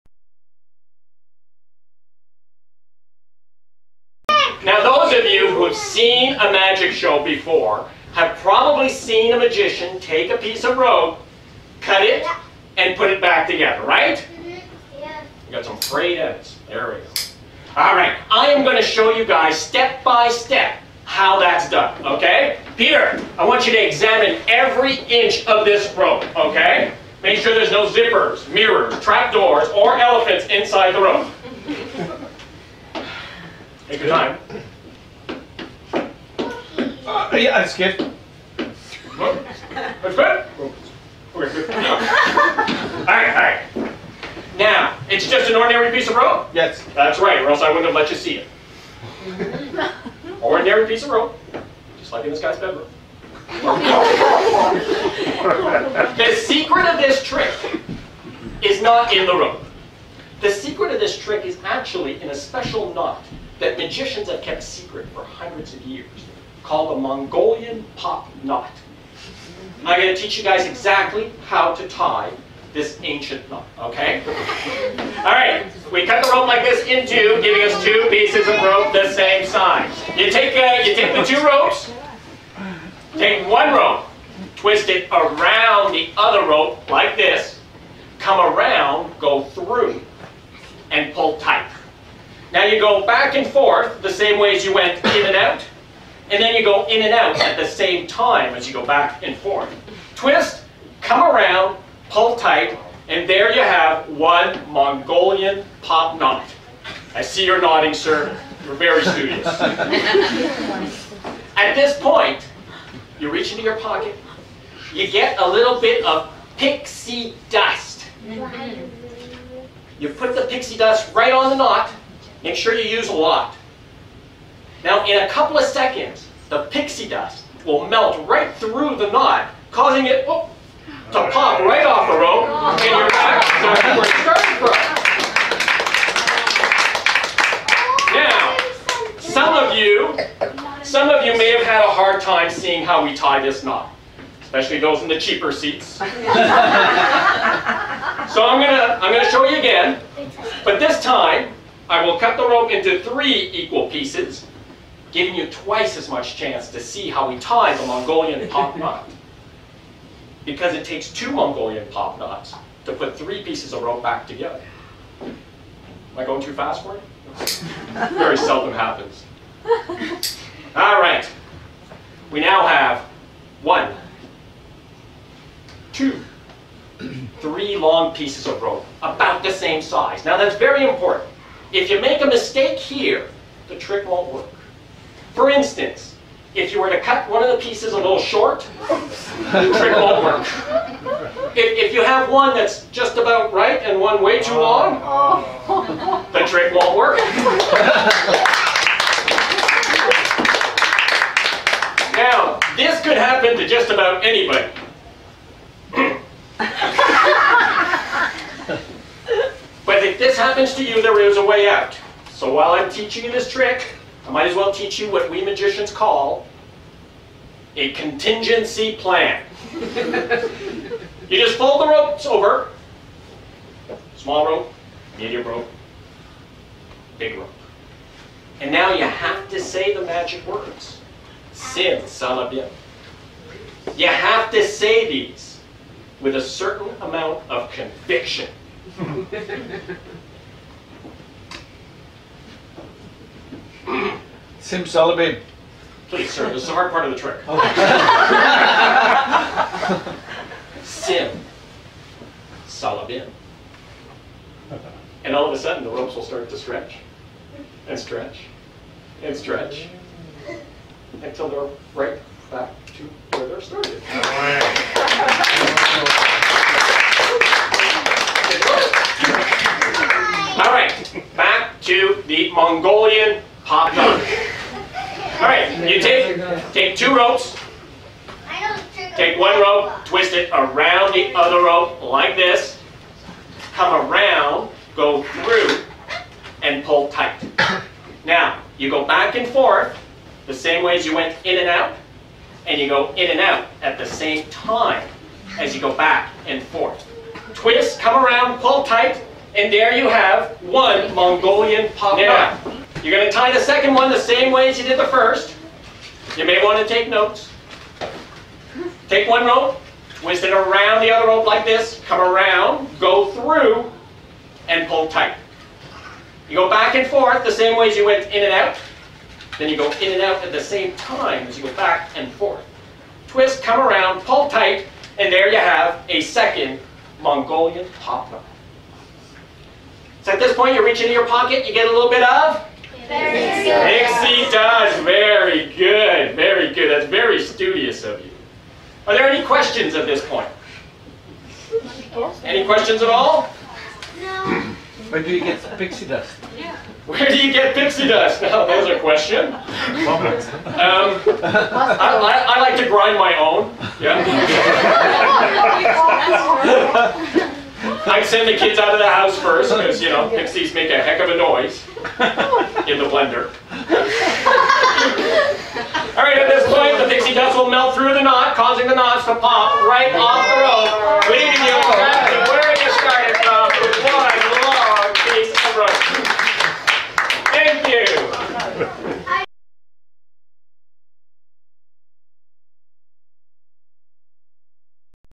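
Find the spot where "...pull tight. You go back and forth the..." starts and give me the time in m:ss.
5:14.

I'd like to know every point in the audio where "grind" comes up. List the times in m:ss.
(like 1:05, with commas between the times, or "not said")
5:52.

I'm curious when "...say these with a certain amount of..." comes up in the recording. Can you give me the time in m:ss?
3:54.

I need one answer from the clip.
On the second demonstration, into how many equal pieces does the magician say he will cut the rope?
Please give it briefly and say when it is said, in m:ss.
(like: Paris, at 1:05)
3, at 2:33.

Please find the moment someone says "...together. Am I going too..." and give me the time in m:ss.
2:44.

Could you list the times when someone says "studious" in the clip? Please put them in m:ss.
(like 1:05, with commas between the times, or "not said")
1:49, 5:37.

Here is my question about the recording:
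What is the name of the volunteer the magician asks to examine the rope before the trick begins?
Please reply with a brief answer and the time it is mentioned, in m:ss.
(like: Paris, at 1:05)
Peter, at 0:22.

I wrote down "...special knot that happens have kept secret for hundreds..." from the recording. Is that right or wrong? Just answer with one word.
wrong.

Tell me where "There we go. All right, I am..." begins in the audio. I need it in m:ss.
0:16.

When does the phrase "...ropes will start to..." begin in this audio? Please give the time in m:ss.
4:15.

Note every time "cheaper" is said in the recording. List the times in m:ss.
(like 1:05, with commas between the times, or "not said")
2:25.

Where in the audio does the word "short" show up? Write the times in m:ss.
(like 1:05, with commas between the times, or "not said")
3:08.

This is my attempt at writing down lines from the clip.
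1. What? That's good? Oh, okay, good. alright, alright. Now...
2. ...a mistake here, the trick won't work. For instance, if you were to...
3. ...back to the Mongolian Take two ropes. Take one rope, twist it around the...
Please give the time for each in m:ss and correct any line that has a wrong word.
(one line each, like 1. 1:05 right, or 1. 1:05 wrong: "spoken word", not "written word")
1. 0:39 right
2. 3:02 right
3. 4:31 right.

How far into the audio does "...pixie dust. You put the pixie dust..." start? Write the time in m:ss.
1:56.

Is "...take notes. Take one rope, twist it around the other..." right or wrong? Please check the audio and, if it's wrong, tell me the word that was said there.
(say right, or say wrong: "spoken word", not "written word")
right.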